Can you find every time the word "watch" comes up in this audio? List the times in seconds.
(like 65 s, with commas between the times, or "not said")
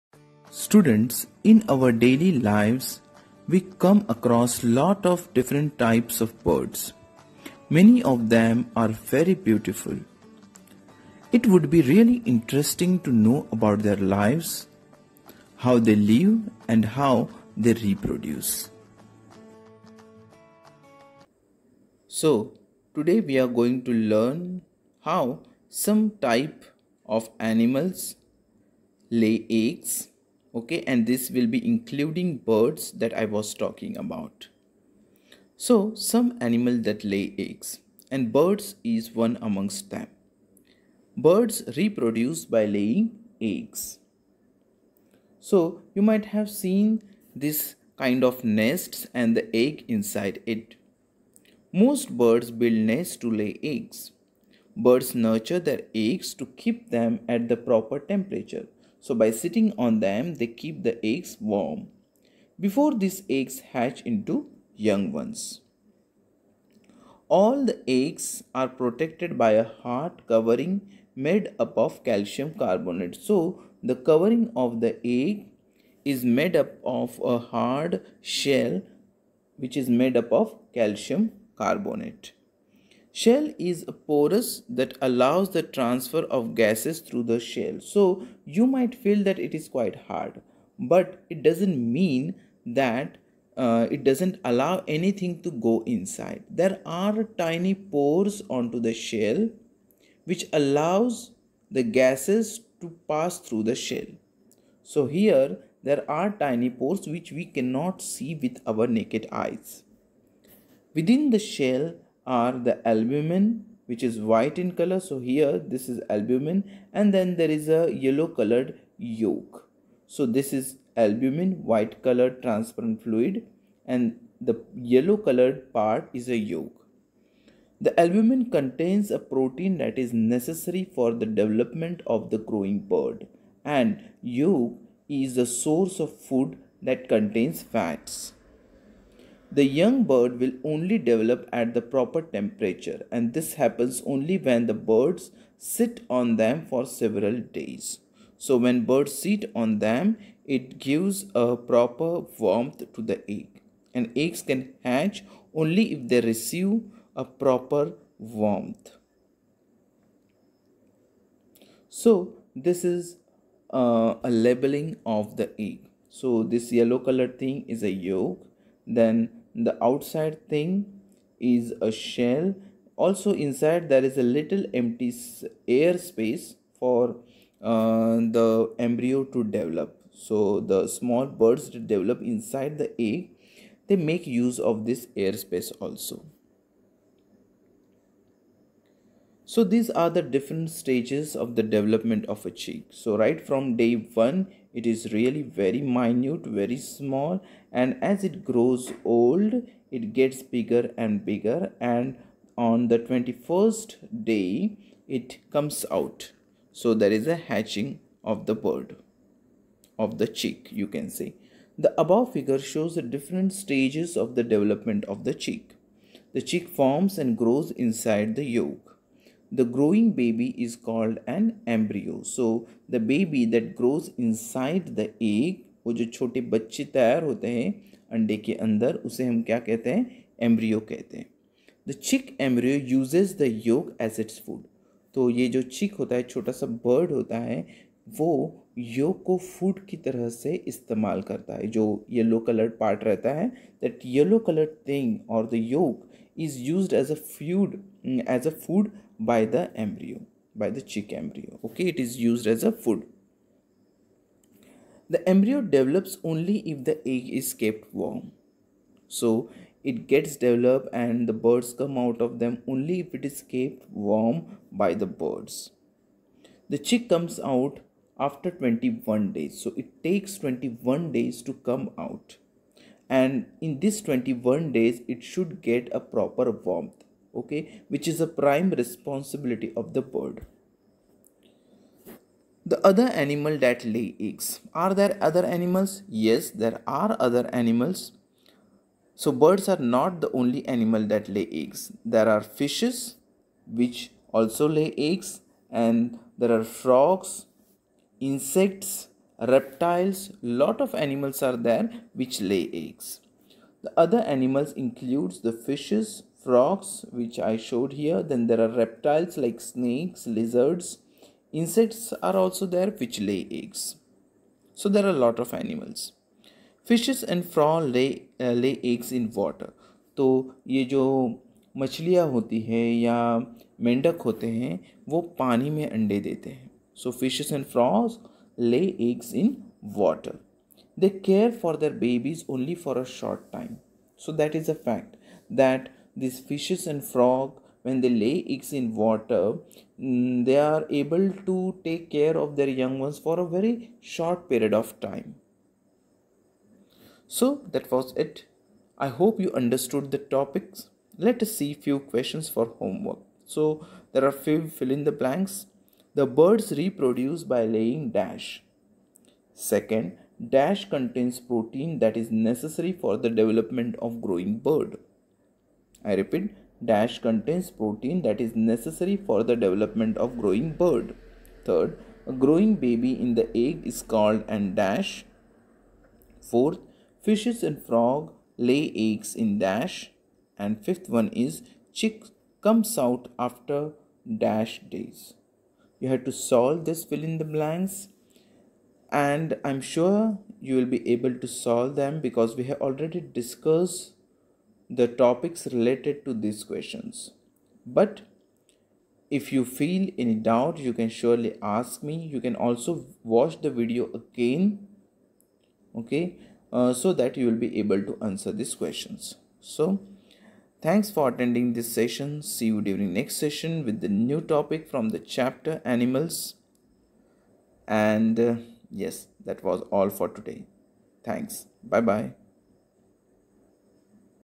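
403 s.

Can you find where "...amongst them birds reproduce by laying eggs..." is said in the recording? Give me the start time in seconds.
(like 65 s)
39 s.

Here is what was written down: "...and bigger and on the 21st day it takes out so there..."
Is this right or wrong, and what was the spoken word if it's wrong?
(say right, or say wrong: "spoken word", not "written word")
wrong: "comes", not "takes".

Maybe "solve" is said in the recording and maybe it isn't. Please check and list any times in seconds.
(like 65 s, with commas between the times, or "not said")
386 s, 391 s.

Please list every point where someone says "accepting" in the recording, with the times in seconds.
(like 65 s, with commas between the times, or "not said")
not said.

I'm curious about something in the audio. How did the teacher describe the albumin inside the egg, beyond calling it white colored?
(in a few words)
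transparent fluid.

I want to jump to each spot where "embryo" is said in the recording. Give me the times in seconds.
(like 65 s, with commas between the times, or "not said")
178 s, 221 s.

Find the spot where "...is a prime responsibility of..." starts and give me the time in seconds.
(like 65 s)
278 s.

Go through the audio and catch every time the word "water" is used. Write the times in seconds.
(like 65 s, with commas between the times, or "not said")
329 s, 338 s.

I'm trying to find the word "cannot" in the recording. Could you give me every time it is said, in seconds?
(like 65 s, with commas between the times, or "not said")
107 s.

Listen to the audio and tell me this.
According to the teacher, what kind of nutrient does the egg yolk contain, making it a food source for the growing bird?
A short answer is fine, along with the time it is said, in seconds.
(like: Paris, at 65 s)
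fats, at 137 s.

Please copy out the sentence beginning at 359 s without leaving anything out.
Second, dash contains protein that is necessary for the development of growing bird.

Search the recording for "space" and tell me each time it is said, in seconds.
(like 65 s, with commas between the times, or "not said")
175 s, 185 s.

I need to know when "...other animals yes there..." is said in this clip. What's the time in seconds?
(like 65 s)
285 s.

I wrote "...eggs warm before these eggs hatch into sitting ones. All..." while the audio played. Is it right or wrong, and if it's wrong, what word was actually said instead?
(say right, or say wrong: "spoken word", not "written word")
wrong: "young", not "sitting".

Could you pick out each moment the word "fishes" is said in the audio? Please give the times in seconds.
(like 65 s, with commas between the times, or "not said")
292 s, 305 s, 327 s, 336 s, 377 s.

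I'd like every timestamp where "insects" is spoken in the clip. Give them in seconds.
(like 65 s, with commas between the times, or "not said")
298 s, 311 s.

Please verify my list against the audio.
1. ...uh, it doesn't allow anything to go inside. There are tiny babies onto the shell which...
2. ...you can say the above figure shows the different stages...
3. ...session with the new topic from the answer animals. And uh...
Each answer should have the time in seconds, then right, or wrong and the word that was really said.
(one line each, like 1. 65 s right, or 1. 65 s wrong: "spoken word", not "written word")
1. 93 s wrong: "pores", not "babies"
2. 210 s right
3. 413 s wrong: "chapter", not "answer".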